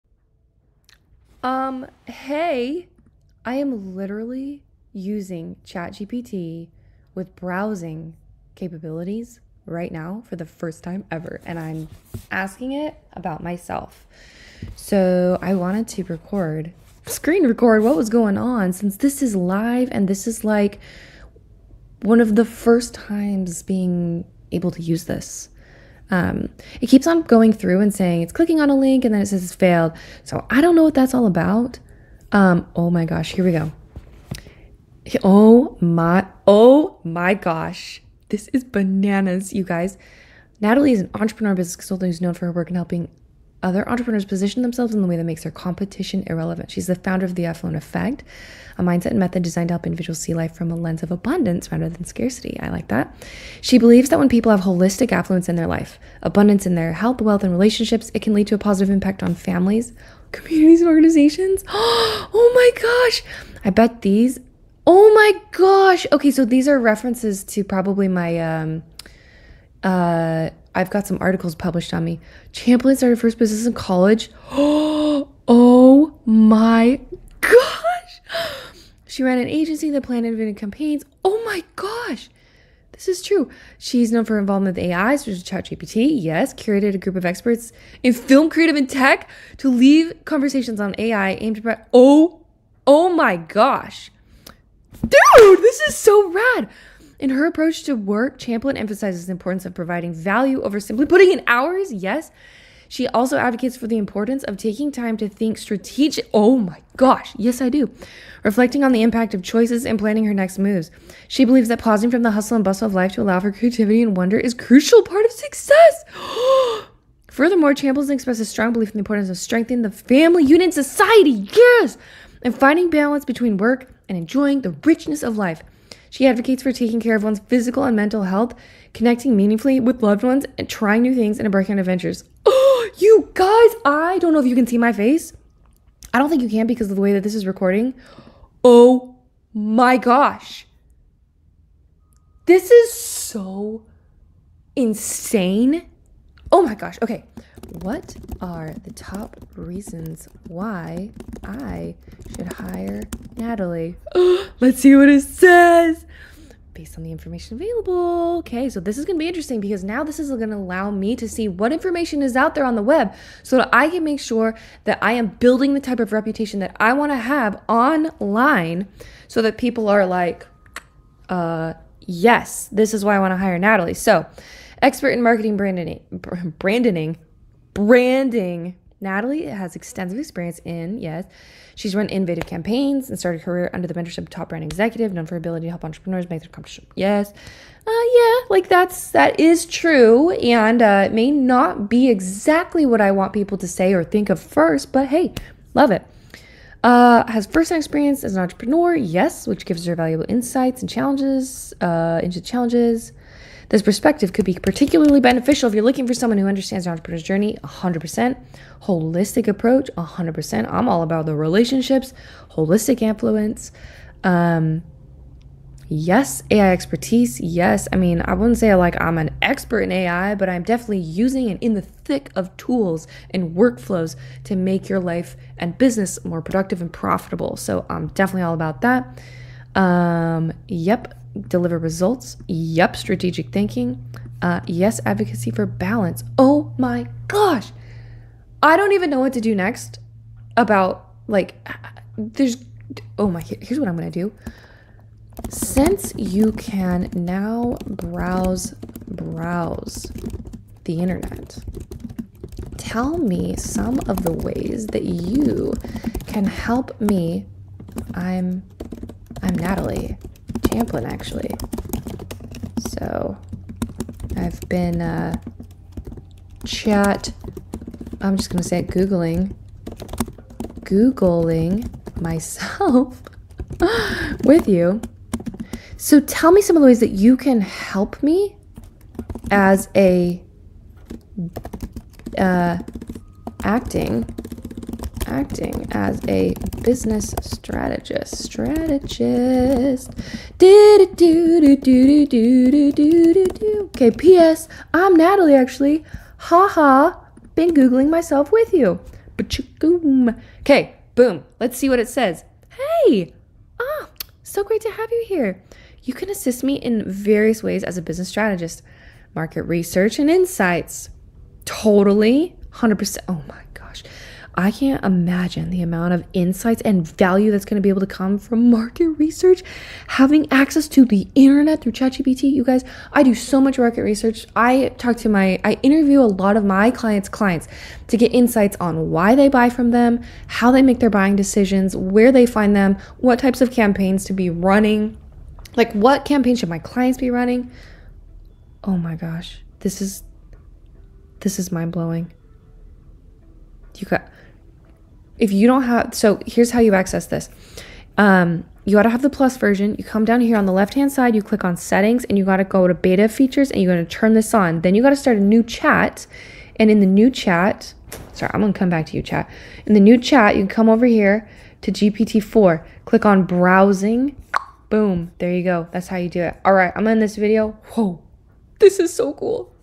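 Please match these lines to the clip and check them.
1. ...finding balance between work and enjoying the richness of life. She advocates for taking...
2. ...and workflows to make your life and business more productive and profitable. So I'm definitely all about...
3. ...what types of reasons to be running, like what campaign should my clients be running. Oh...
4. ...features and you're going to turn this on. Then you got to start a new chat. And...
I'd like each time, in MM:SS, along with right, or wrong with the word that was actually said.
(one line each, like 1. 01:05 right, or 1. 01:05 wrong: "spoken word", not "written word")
1. 02:02 right
2. 03:43 right
3. 05:33 wrong: "campaigns", not "reasons"
4. 05:53 right.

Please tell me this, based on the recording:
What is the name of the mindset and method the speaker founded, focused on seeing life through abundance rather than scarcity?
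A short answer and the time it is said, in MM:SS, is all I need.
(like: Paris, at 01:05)
The Affluent Effect, at 00:47.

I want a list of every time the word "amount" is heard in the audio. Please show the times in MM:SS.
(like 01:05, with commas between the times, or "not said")
05:15.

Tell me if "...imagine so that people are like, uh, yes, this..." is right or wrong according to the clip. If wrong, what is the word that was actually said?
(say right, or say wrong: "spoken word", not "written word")
wrong: "online", not "imagine".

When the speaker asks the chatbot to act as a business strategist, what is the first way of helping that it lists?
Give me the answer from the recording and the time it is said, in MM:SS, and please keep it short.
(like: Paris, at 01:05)
Market research and insights, at 05:09.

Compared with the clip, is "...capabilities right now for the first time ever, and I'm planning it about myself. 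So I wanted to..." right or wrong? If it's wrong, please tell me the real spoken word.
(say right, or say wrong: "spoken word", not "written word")
wrong: "asking", not "planning".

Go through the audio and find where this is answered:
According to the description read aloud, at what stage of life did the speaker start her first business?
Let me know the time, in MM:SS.
01:13.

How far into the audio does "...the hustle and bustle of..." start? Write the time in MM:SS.
01:52.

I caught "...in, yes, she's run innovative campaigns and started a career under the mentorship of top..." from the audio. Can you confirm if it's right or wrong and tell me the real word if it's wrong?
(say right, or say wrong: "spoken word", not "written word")
right.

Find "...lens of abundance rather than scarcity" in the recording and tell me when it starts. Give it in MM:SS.
00:50.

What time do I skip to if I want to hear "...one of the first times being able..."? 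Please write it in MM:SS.
00:22.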